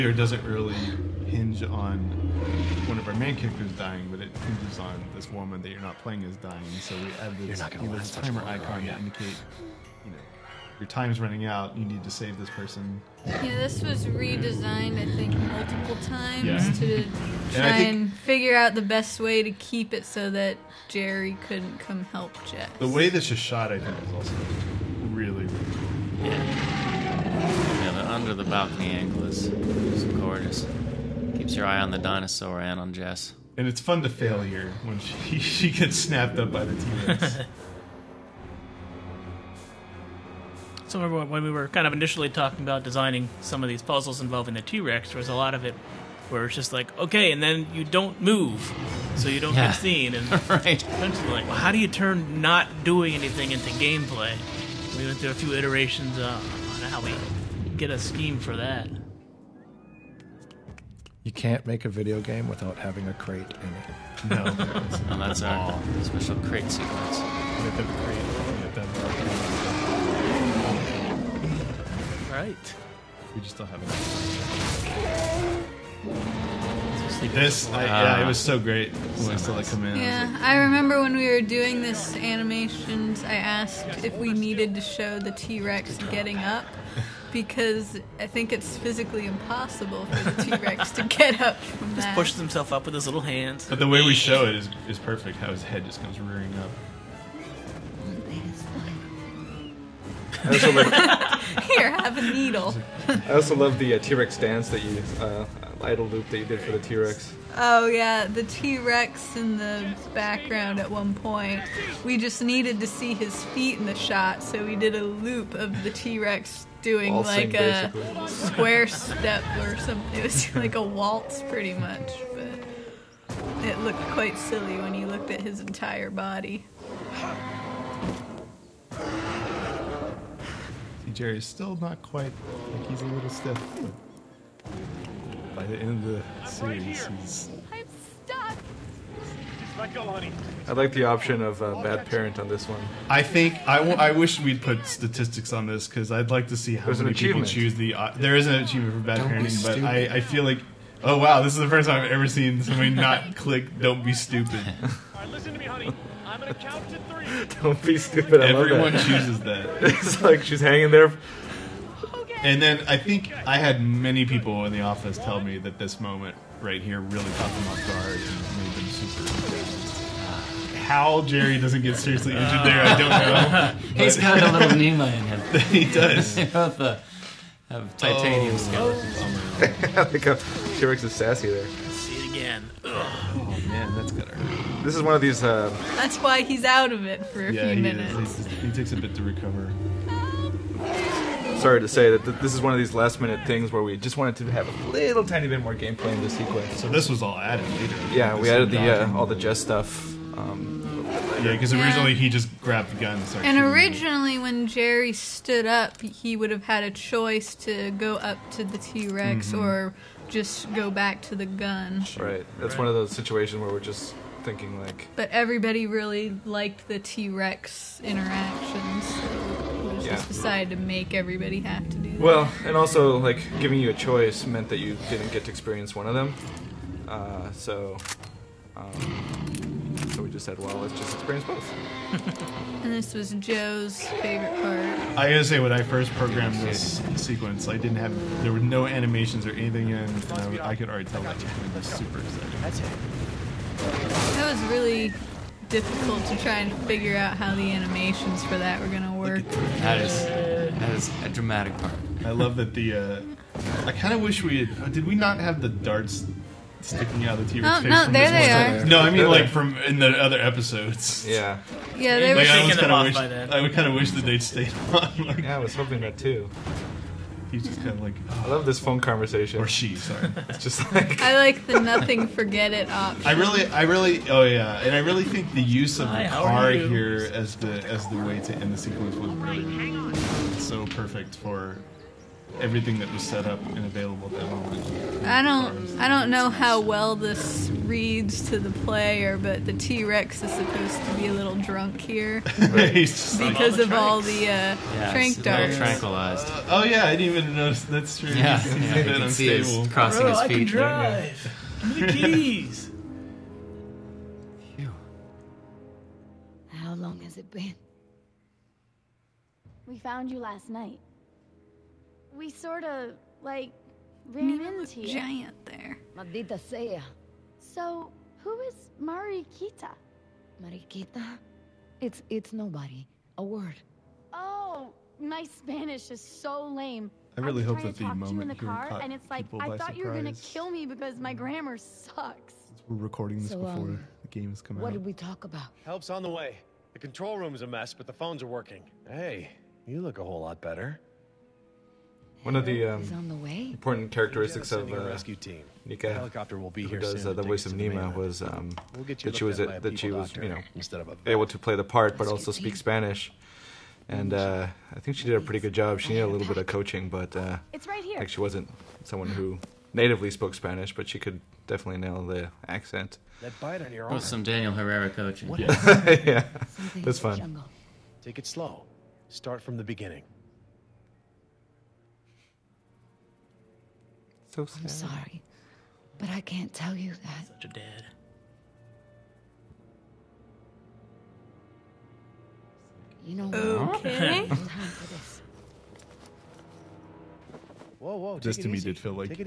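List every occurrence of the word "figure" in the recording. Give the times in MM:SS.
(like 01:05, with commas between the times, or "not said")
00:18, 04:06.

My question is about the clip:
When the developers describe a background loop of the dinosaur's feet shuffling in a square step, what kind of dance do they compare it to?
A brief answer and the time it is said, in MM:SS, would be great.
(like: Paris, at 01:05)
Waltz, at 02:00.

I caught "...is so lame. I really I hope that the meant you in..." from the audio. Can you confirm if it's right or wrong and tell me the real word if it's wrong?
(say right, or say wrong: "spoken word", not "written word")
wrong: "moment", not "meant".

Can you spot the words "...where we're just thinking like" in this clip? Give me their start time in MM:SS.
03:33.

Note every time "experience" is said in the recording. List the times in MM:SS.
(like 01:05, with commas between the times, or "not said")
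03:45, 03:51.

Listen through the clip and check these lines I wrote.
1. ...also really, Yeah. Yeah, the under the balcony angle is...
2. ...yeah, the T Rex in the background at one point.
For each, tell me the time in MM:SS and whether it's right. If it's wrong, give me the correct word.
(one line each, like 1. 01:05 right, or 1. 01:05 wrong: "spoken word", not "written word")
1. 00:24 right
2. 01:47 right.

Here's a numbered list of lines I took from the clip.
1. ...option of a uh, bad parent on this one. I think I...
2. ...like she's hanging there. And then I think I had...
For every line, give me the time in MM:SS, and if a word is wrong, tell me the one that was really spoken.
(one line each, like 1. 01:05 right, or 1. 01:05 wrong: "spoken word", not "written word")
1. 02:21 right
2. 02:40 right.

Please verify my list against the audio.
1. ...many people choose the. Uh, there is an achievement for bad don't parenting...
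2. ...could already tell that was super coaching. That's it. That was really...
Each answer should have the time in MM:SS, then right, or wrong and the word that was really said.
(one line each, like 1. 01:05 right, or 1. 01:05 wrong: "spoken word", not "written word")
1. 02:27 right
2. 04:00 wrong: "exciting", not "coaching".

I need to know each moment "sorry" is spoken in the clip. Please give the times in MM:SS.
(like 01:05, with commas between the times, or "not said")
03:11, 04:29, 06:14.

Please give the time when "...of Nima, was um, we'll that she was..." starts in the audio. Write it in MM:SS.
05:47.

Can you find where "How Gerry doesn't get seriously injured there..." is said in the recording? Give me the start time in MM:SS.
02:50.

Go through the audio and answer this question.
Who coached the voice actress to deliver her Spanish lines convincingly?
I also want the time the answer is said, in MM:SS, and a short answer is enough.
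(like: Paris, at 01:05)
Daniel Herrera, at 06:04.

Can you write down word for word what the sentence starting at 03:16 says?
So this was all added later.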